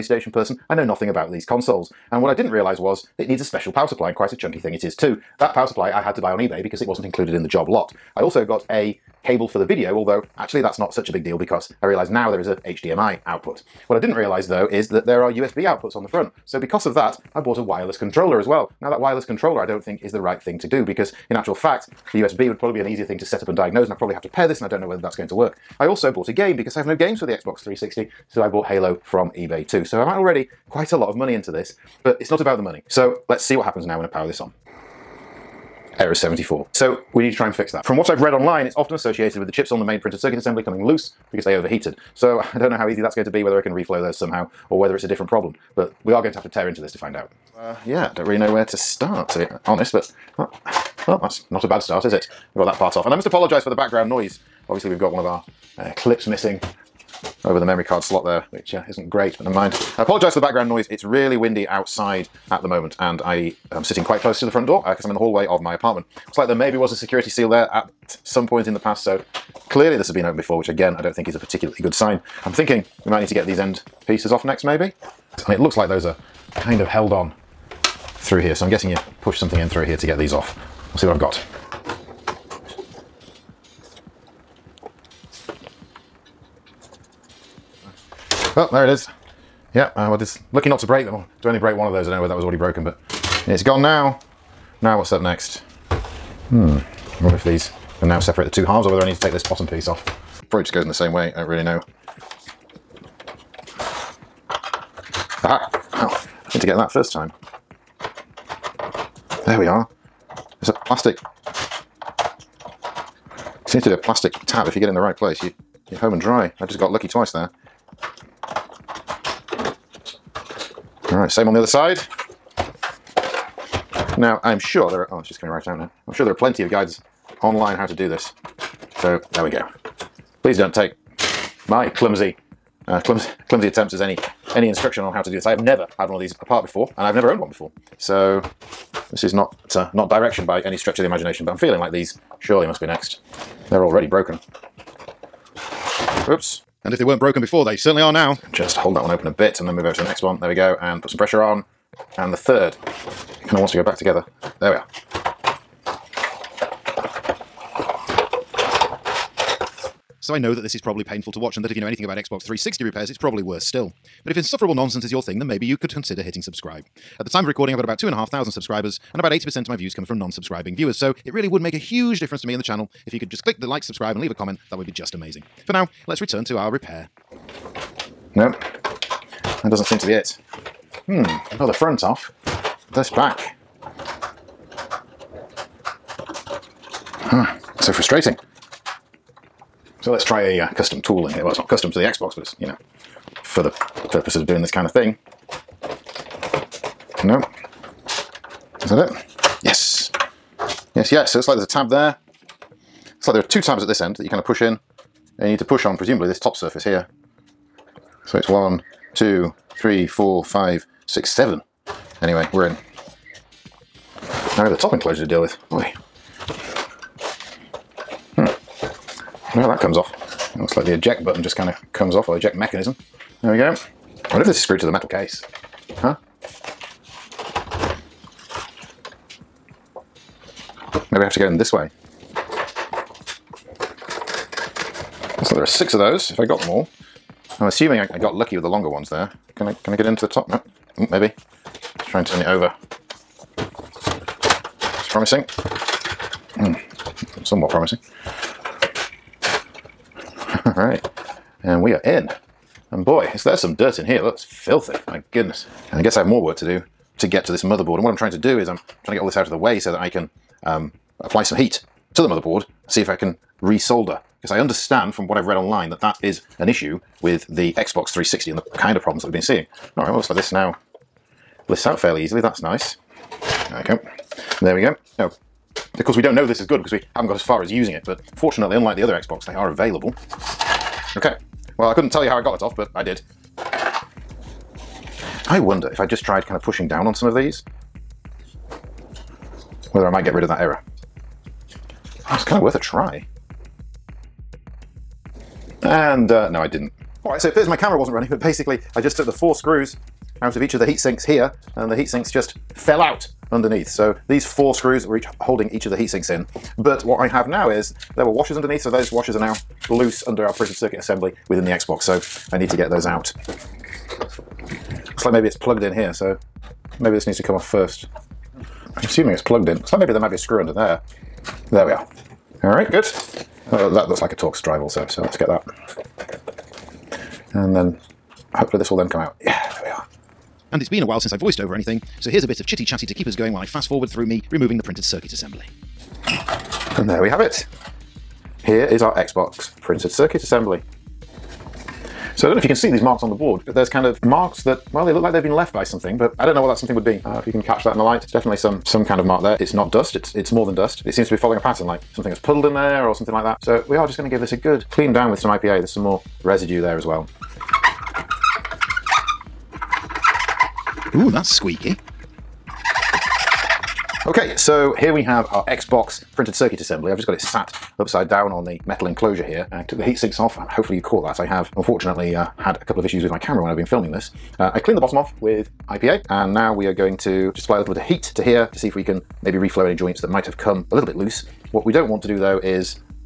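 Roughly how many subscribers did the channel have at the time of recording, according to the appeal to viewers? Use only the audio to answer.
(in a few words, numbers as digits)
2,500.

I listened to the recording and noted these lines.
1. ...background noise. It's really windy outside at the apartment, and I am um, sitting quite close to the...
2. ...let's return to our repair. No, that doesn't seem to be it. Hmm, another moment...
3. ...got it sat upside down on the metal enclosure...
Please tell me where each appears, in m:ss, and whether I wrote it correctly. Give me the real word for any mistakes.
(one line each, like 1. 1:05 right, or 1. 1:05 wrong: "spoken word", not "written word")
1. 1:00 wrong: "moment", not "apartment"
2. 2:56 wrong: "front", not "moment"
3. 6:07 right.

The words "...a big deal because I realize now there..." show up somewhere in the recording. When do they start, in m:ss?
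0:11.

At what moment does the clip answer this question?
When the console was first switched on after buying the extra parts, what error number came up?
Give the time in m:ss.
0:35.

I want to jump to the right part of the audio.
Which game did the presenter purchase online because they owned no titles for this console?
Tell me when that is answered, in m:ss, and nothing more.
0:28.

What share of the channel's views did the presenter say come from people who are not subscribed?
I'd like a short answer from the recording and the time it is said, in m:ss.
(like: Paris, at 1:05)
80%, at 2:49.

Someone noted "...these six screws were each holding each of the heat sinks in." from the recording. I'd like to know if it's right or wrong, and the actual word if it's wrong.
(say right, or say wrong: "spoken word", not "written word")
wrong: "four", not "six".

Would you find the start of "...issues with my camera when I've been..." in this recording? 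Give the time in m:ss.
6:13.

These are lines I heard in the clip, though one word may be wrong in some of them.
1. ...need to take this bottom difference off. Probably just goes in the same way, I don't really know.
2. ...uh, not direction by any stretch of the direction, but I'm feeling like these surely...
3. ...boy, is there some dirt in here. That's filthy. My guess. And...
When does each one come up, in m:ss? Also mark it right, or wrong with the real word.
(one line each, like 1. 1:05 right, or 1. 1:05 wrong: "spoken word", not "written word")
1. 1:39 wrong: "piece", not "difference"
2. 2:19 wrong: "imagination", not "direction"
3. 4:13 wrong: "goodness", not "guess".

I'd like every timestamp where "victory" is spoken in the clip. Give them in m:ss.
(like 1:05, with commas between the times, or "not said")
not said.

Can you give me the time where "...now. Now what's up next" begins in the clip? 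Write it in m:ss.
1:33.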